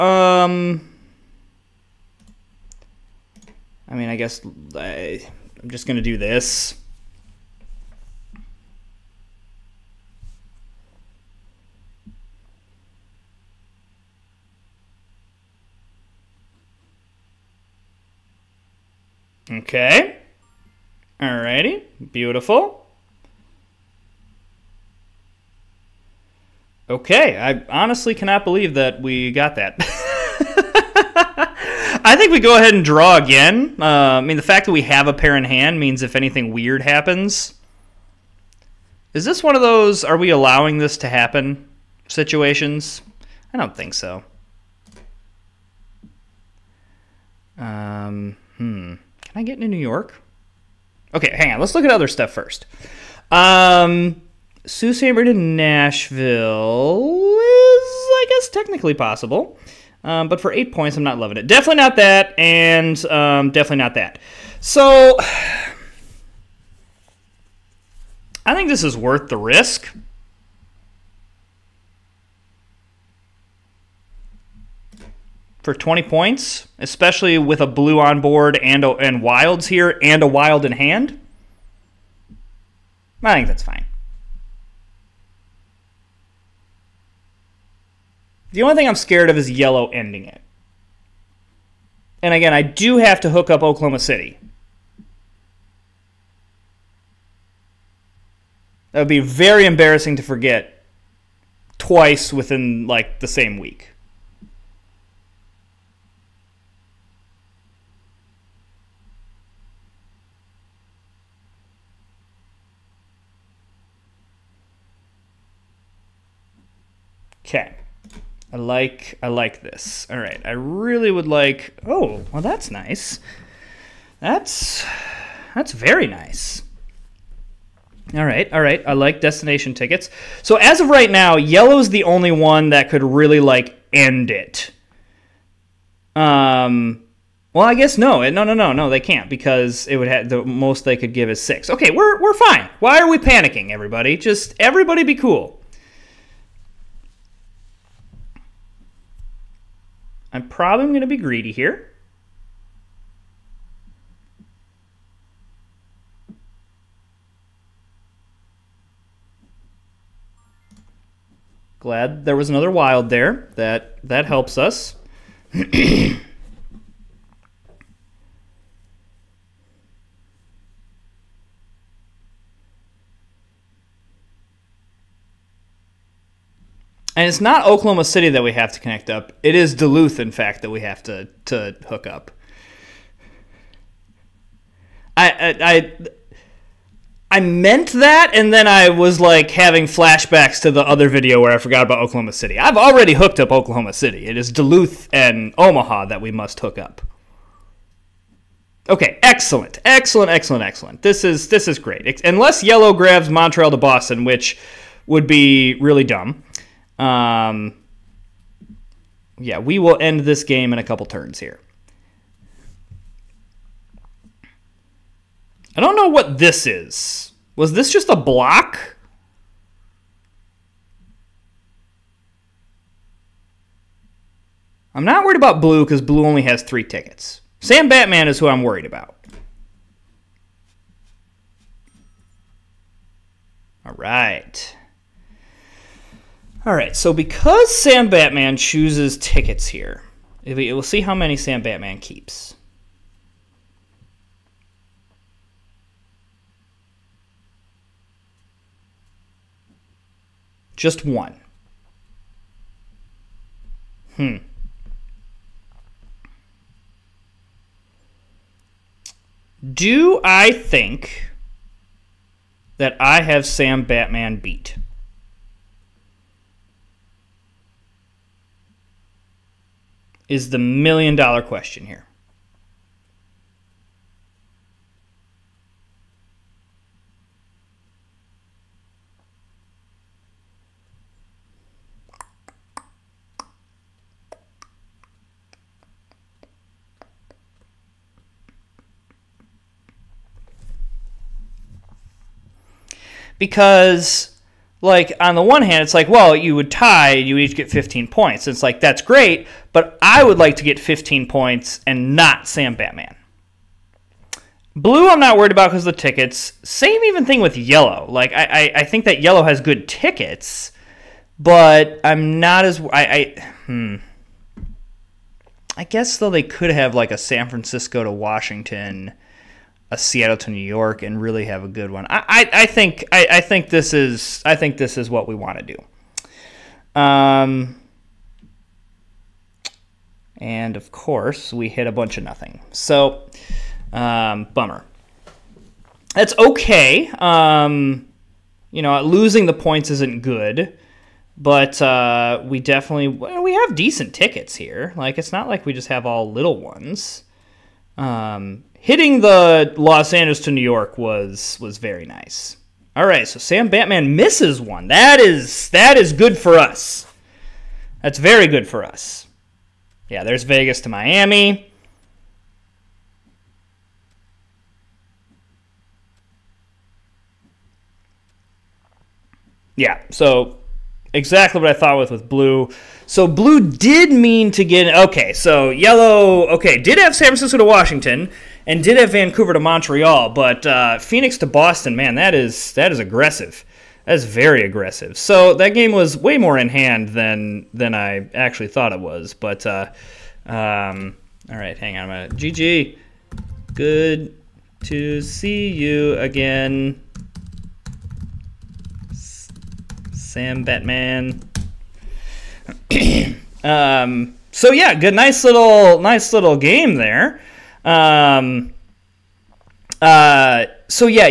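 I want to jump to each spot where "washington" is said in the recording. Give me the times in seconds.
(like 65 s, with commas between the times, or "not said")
318 s, 377 s.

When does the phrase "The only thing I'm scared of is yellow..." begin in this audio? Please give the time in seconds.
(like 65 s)
88 s.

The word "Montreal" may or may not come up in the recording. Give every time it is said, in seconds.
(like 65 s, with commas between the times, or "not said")
203 s, 379 s.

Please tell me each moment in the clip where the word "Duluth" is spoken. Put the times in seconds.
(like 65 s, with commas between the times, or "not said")
179 s, 194 s.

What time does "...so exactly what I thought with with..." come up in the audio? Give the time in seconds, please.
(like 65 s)
370 s.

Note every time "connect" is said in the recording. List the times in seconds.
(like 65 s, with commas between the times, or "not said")
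178 s.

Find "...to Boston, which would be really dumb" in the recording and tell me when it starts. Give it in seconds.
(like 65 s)
203 s.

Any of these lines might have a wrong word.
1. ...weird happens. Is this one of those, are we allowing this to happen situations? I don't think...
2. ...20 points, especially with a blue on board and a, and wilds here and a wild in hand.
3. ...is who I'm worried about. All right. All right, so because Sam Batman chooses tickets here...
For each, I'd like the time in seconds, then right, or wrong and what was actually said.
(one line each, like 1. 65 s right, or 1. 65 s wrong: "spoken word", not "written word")
1. 36 s right
2. 75 s right
3. 228 s right.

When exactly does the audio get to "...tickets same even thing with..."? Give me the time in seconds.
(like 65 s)
305 s.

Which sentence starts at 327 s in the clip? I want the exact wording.
Um, and of course we hit a bunch of nothing.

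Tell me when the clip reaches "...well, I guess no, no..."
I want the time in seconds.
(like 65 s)
137 s.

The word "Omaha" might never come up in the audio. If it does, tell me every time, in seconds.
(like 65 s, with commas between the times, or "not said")
195 s.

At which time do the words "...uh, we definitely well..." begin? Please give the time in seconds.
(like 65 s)
341 s.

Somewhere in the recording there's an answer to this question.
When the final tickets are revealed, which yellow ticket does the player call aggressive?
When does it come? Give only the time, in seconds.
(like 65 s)
380 s.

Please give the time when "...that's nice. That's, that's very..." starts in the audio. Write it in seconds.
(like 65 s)
122 s.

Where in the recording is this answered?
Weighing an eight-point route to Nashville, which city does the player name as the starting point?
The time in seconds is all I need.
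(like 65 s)
54 s.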